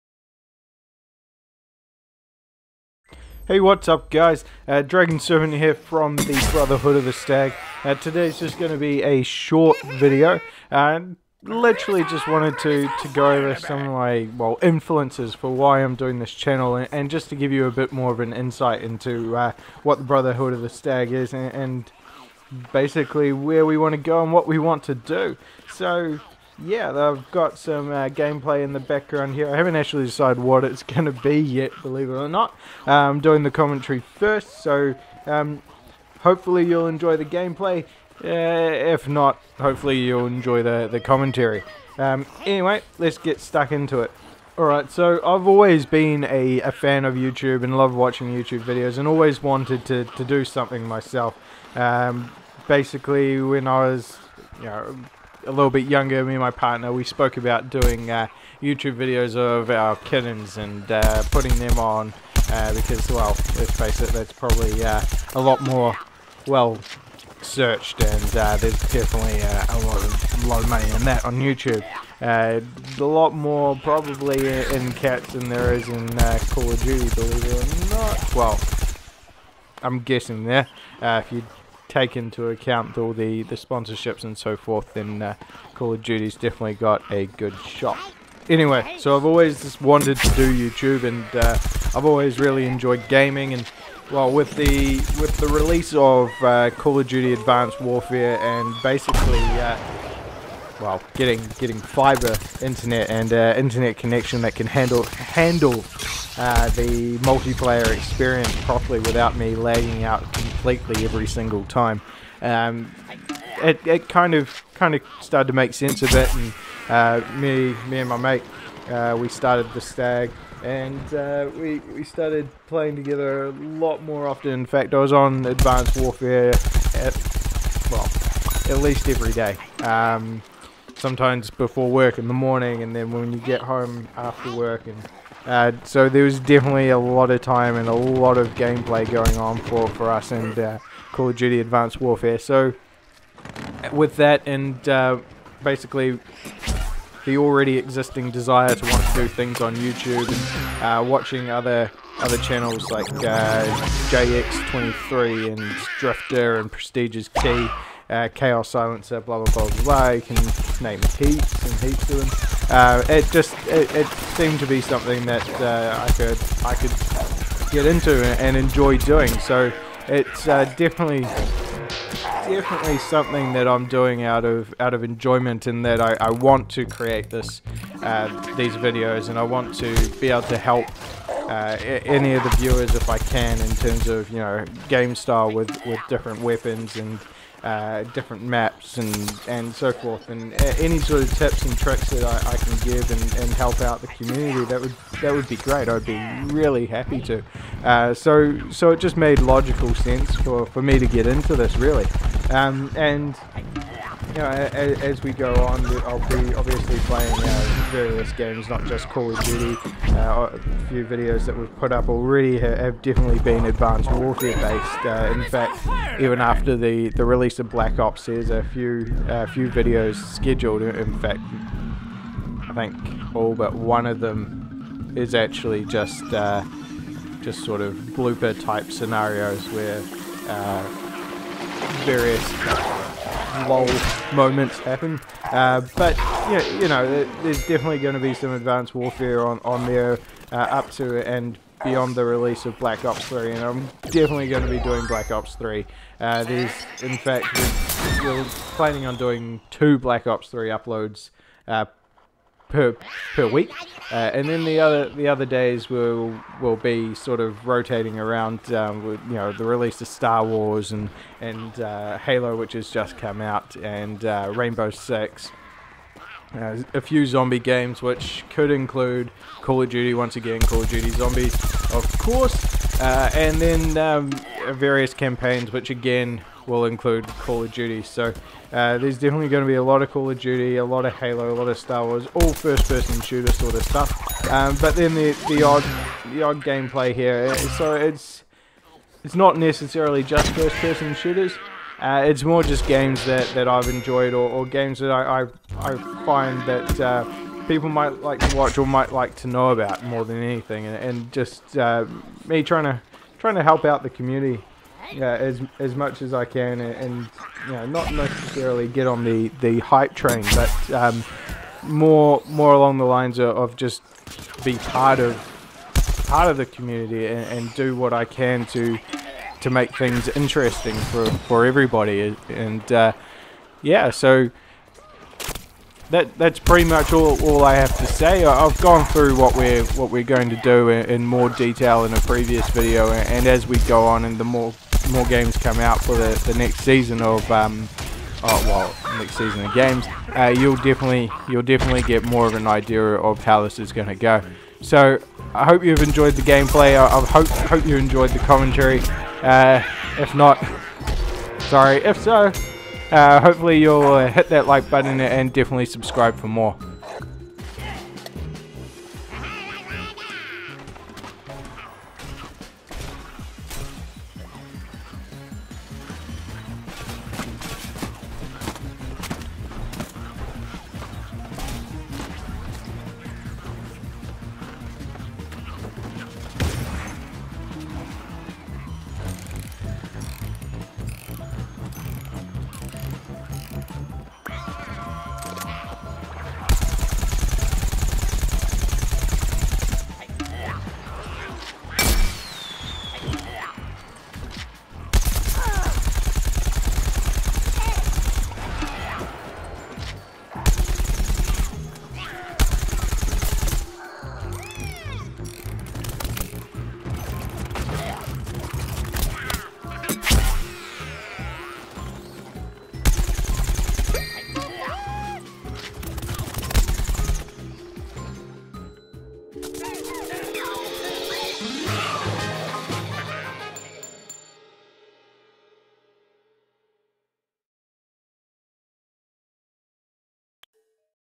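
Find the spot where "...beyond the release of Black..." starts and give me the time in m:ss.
4:01.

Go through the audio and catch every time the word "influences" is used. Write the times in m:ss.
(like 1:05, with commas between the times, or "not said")
0:14.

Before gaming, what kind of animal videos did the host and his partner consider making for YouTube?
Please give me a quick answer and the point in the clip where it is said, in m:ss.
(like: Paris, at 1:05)
Kittens, at 0:59.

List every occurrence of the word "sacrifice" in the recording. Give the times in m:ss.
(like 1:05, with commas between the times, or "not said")
not said.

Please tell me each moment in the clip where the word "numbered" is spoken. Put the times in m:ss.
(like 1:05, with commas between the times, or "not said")
not said.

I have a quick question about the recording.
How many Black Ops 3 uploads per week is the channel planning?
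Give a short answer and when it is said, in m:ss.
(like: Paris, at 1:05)
2, at 4:09.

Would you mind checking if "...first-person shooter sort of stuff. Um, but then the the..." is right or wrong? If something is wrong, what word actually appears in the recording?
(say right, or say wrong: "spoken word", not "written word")
right.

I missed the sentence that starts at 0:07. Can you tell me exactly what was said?
Uh, today's just going to be a short video.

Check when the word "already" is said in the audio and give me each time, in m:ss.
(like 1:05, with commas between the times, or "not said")
2:27, 3:32.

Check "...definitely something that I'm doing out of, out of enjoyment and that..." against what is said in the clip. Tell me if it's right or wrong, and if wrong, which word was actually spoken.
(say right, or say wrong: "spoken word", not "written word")
right.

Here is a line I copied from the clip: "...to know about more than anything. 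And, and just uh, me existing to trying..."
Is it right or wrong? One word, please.
wrong.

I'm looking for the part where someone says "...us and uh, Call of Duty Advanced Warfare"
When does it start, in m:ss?
2:20.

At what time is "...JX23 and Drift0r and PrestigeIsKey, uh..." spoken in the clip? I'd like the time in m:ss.
2:34.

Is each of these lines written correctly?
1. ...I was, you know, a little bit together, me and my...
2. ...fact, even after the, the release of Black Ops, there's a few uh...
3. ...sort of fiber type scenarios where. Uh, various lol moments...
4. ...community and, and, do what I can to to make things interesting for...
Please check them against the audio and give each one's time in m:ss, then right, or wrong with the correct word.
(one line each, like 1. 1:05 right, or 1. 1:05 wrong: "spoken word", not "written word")
1. 0:53 wrong: "younger", not "together"
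2. 3:35 right
3. 3:47 wrong: "blooper", not "fiber"
4. 5:16 right.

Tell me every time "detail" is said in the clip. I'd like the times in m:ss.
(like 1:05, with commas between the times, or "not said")
5:31.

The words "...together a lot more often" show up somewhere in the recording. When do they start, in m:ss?
2:02.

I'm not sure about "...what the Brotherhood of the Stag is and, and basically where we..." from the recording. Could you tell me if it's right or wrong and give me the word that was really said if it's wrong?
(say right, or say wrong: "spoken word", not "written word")
right.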